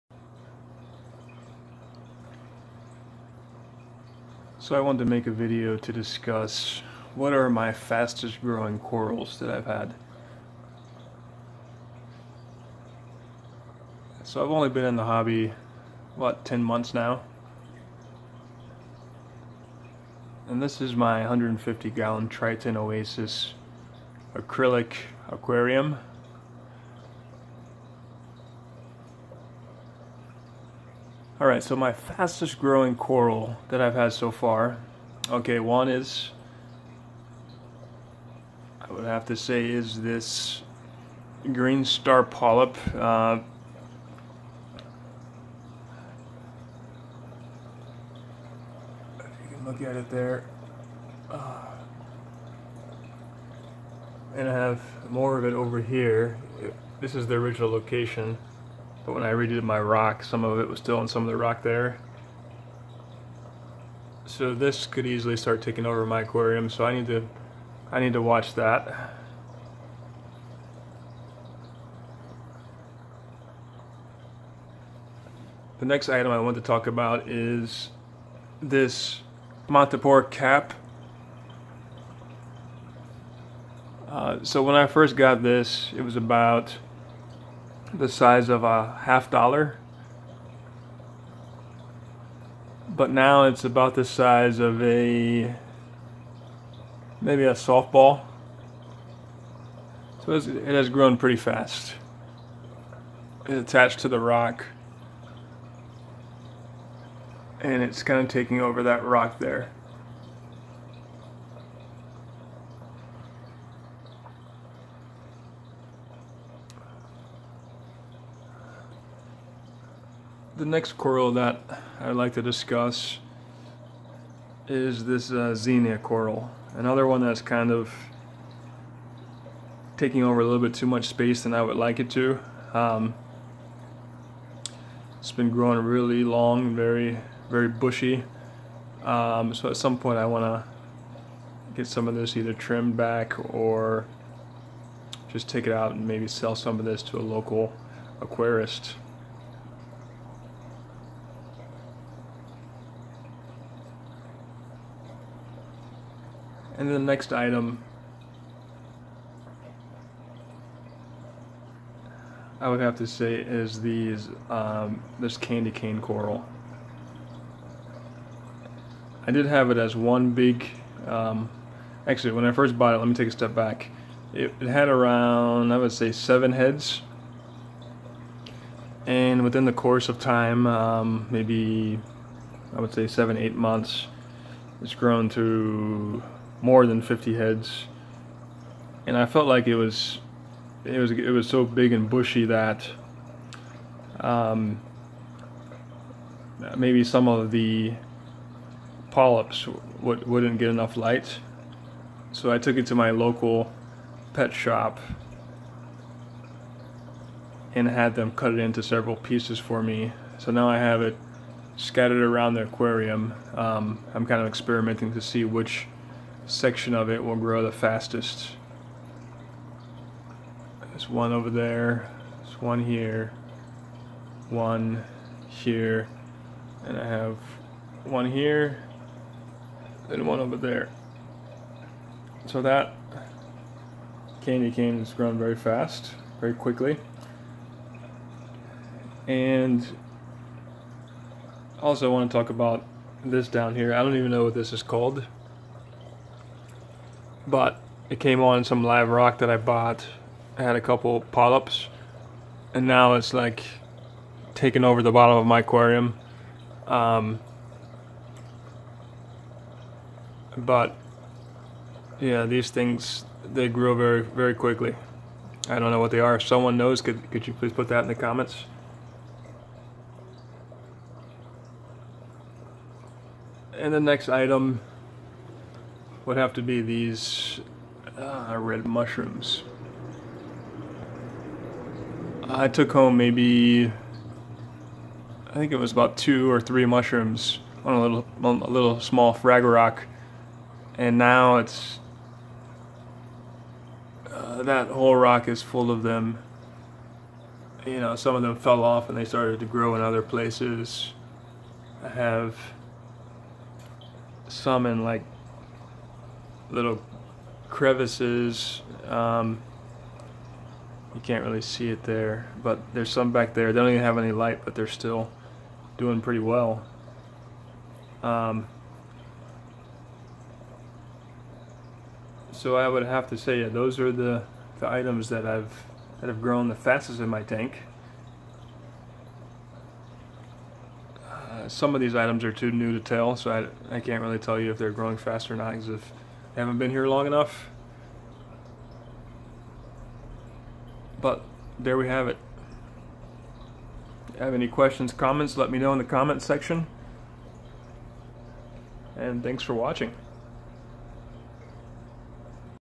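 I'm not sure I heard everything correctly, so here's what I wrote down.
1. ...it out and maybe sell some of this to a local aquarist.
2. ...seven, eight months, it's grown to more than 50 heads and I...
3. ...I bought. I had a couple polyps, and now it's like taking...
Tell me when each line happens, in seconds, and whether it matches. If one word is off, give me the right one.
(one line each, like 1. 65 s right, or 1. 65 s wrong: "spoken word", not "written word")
1. 145 s right
2. 183 s right
3. 249 s right.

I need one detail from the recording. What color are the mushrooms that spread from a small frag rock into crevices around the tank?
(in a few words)
Red.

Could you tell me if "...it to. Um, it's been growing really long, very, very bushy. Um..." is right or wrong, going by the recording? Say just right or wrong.
right.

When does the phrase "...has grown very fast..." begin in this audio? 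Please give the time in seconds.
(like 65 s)
234 s.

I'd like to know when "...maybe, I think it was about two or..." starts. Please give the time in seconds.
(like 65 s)
283 s.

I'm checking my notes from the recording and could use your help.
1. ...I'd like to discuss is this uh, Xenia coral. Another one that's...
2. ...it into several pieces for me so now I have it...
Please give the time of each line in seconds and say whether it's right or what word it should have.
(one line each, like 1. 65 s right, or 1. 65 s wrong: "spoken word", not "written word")
1. 121 s right
2. 208 s right.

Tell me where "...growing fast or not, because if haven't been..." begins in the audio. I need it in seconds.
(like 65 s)
334 s.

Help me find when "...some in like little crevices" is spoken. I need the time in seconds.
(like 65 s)
304 s.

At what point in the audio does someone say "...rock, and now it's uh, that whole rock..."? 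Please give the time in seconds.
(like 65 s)
289 s.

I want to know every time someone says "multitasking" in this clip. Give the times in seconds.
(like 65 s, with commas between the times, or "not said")
not said.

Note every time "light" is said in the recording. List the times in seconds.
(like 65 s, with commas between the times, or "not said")
200 s, 314 s.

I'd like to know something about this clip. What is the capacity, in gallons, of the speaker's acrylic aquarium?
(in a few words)
150 gallons.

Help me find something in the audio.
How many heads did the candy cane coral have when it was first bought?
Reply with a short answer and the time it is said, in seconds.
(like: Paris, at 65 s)
7, at 176 s.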